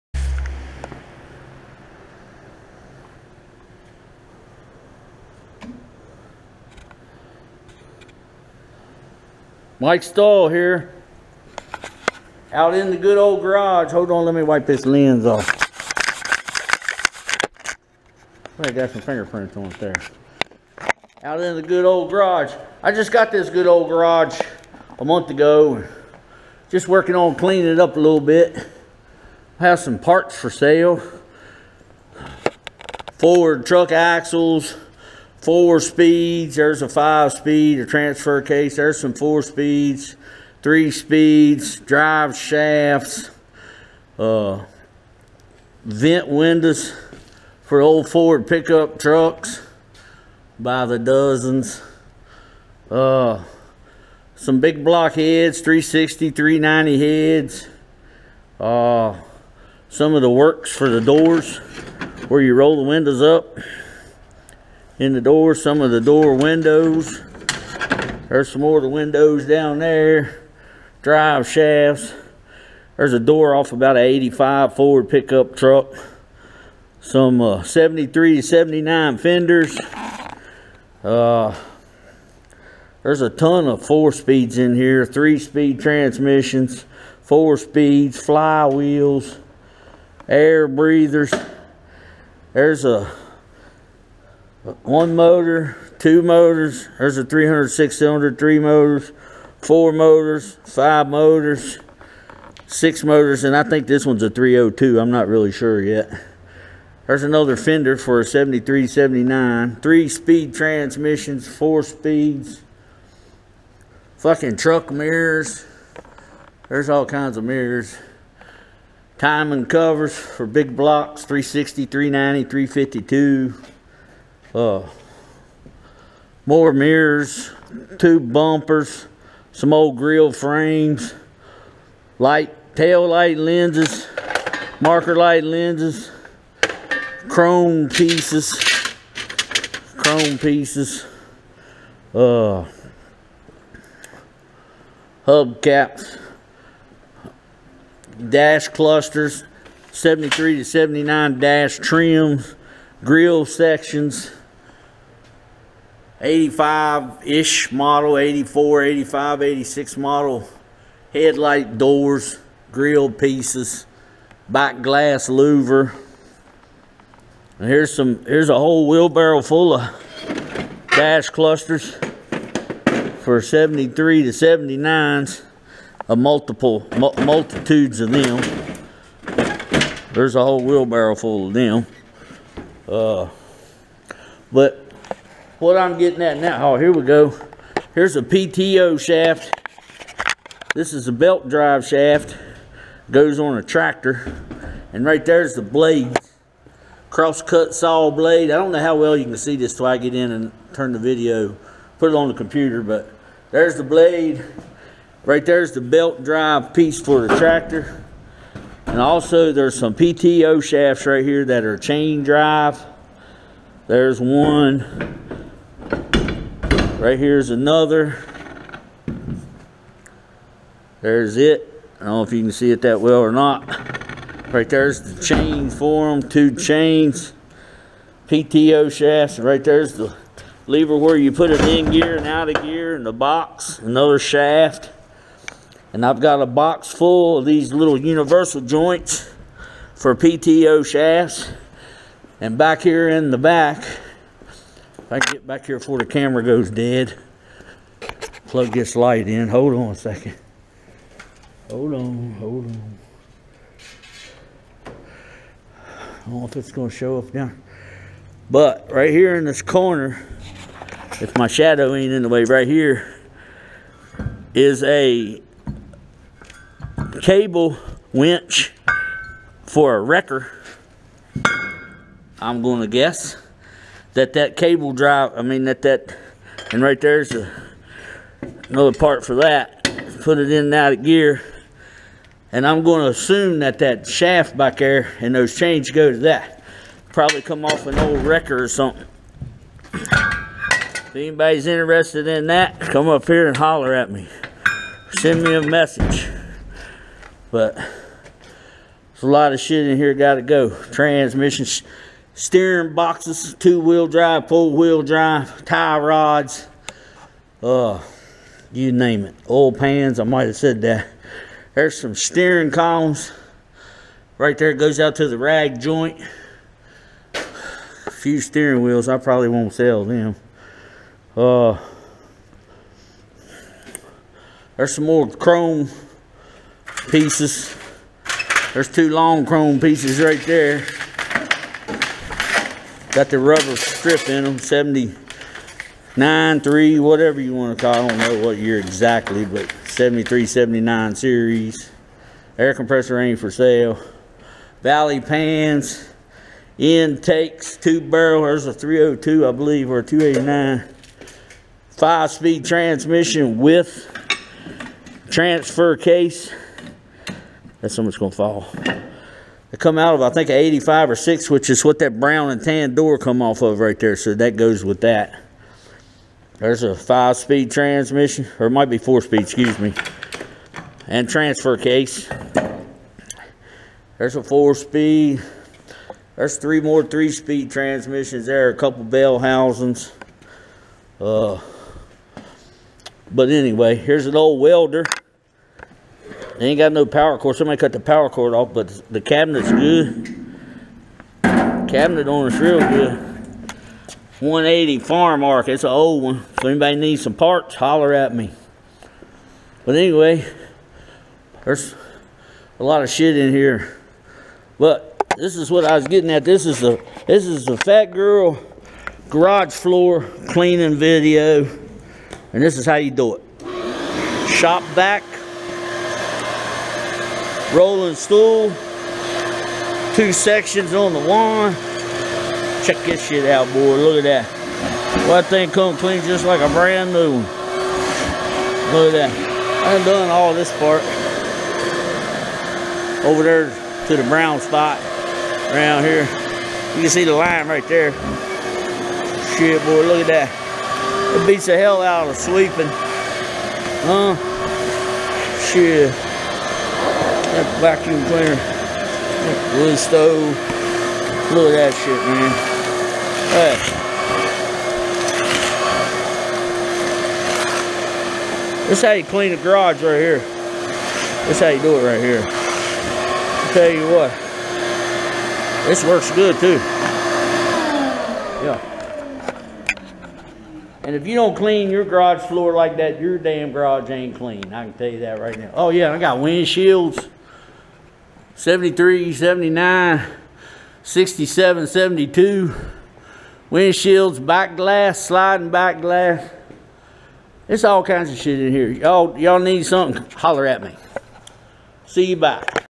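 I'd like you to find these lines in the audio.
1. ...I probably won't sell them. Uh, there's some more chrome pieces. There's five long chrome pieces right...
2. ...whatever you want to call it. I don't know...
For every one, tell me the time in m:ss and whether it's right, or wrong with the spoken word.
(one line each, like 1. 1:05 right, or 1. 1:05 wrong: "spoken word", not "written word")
1. 5:19 wrong: "two", not "five"
2. 5:37 right.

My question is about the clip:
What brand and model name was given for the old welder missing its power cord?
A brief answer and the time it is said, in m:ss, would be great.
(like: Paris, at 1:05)
180 Farm Arc, at 6:34.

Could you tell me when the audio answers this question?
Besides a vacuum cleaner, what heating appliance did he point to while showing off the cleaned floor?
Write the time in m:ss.
7:29.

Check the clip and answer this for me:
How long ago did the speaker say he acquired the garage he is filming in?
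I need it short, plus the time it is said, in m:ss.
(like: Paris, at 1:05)
a month ago, at 0:24.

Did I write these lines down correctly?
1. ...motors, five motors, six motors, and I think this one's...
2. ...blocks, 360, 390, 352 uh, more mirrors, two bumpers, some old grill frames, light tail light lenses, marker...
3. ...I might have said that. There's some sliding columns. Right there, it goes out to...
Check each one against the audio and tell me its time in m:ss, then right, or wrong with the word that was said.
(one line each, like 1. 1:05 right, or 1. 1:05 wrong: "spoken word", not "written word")
1. 1:39 right
2. 2:00 right
3. 5:10 wrong: "steering", not "sliding".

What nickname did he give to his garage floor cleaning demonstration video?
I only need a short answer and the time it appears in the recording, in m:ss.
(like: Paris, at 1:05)
fat girl, at 6:47.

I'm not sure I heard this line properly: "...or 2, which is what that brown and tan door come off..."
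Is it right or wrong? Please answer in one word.
wrong.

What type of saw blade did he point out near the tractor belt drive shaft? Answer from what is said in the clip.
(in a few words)
Cross-cut.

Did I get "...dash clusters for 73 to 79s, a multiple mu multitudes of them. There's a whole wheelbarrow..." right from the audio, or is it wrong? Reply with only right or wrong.
right.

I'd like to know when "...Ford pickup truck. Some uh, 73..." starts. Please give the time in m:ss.
1:14.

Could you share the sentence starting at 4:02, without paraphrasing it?
And back here in the back, I can get back here before the camera goes dead, plug this light in.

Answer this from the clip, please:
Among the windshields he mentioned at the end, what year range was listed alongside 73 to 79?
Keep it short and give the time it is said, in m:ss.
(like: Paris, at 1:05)
67-72, at 8:01.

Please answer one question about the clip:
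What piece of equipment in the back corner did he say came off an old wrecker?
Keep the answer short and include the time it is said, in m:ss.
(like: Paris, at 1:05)
cable winch, at 4:27.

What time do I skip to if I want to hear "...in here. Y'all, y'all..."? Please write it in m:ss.
8:08.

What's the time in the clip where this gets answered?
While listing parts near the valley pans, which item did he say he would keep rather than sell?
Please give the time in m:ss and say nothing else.
5:42.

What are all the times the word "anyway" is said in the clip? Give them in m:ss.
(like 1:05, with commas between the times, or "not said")
6:23, 6:39.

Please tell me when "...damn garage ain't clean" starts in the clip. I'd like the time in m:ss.
7:53.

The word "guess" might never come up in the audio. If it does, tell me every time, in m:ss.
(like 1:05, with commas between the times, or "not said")
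4:32.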